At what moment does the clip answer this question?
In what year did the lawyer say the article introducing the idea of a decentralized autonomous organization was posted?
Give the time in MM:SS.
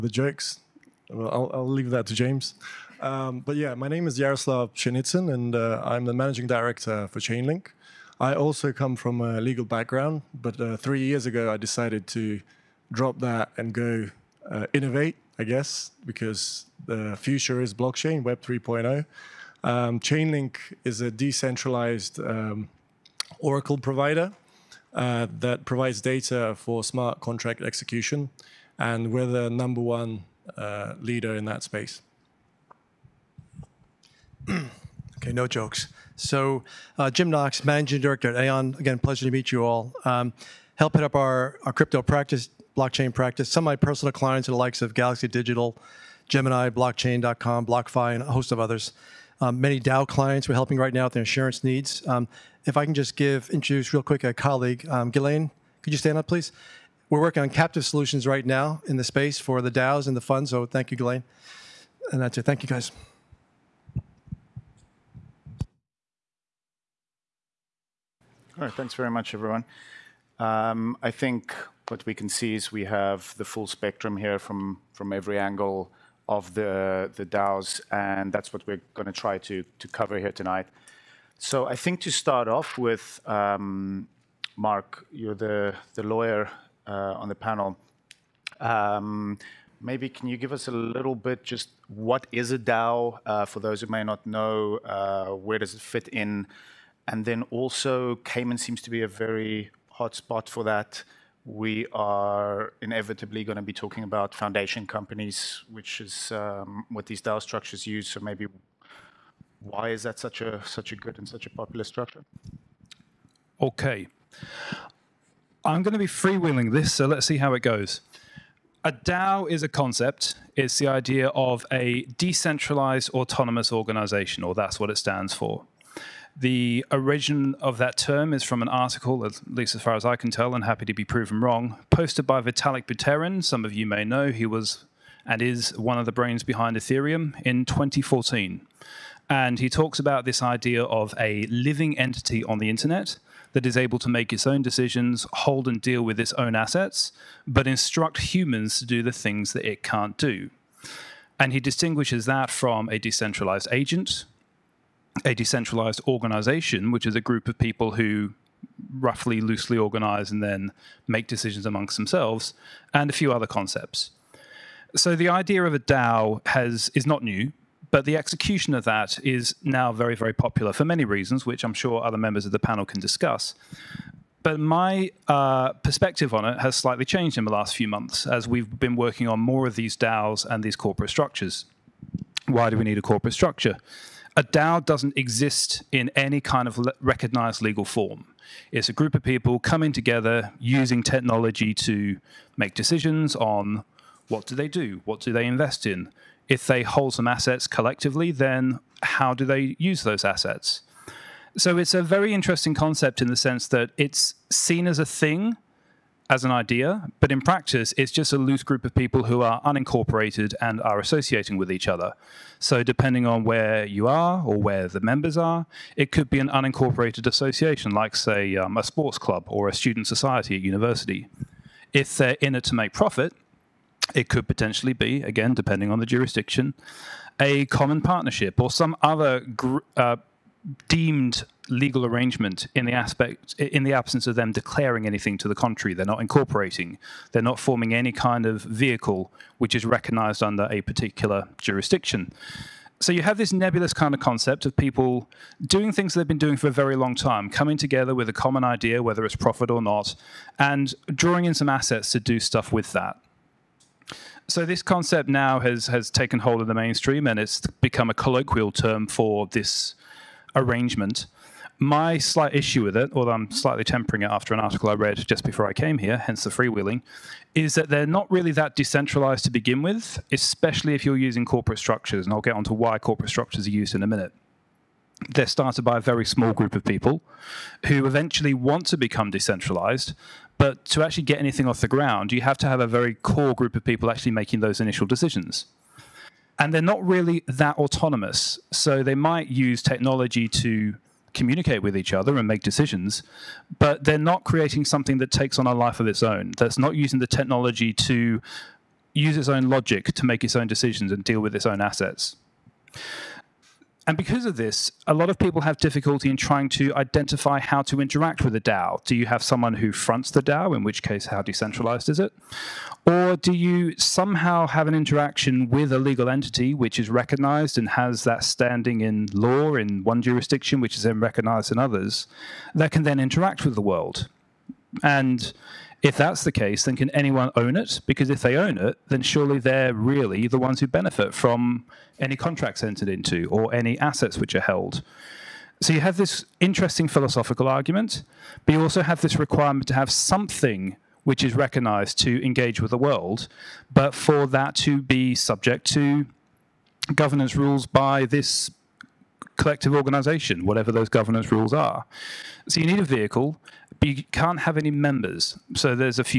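02:17.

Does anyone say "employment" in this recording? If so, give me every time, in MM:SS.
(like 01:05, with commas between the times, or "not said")
not said.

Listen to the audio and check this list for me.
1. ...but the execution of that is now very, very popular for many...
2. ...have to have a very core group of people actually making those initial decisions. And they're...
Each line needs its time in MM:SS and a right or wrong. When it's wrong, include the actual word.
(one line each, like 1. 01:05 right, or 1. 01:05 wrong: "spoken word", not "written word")
1. 02:47 right
2. 04:42 right.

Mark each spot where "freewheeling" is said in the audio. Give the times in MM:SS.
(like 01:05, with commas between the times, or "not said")
01:56, 04:26.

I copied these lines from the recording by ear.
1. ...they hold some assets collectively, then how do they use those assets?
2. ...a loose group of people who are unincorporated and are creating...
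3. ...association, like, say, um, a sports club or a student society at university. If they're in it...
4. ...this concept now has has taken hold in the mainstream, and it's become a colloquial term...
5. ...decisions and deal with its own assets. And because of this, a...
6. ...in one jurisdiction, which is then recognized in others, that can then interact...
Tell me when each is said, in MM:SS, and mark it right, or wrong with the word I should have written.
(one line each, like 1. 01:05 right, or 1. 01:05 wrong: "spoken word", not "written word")
1. 03:16 right
2. 03:28 wrong: "associating", not "creating"
3. 03:37 right
4. 04:14 right
5. 05:00 right
6. 05:19 right.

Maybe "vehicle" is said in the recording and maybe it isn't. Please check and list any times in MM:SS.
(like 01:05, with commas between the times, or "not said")
03:58, 05:53.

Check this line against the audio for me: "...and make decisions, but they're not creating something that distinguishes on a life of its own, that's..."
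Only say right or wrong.
wrong.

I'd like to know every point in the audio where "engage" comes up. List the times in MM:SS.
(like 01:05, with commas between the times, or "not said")
05:42.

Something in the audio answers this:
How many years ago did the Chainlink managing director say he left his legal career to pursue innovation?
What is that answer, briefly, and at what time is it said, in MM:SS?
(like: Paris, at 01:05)
3, at 00:10.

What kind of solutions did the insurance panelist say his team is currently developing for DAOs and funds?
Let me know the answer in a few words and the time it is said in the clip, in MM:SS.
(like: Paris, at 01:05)
Captive solutions, at 00:57.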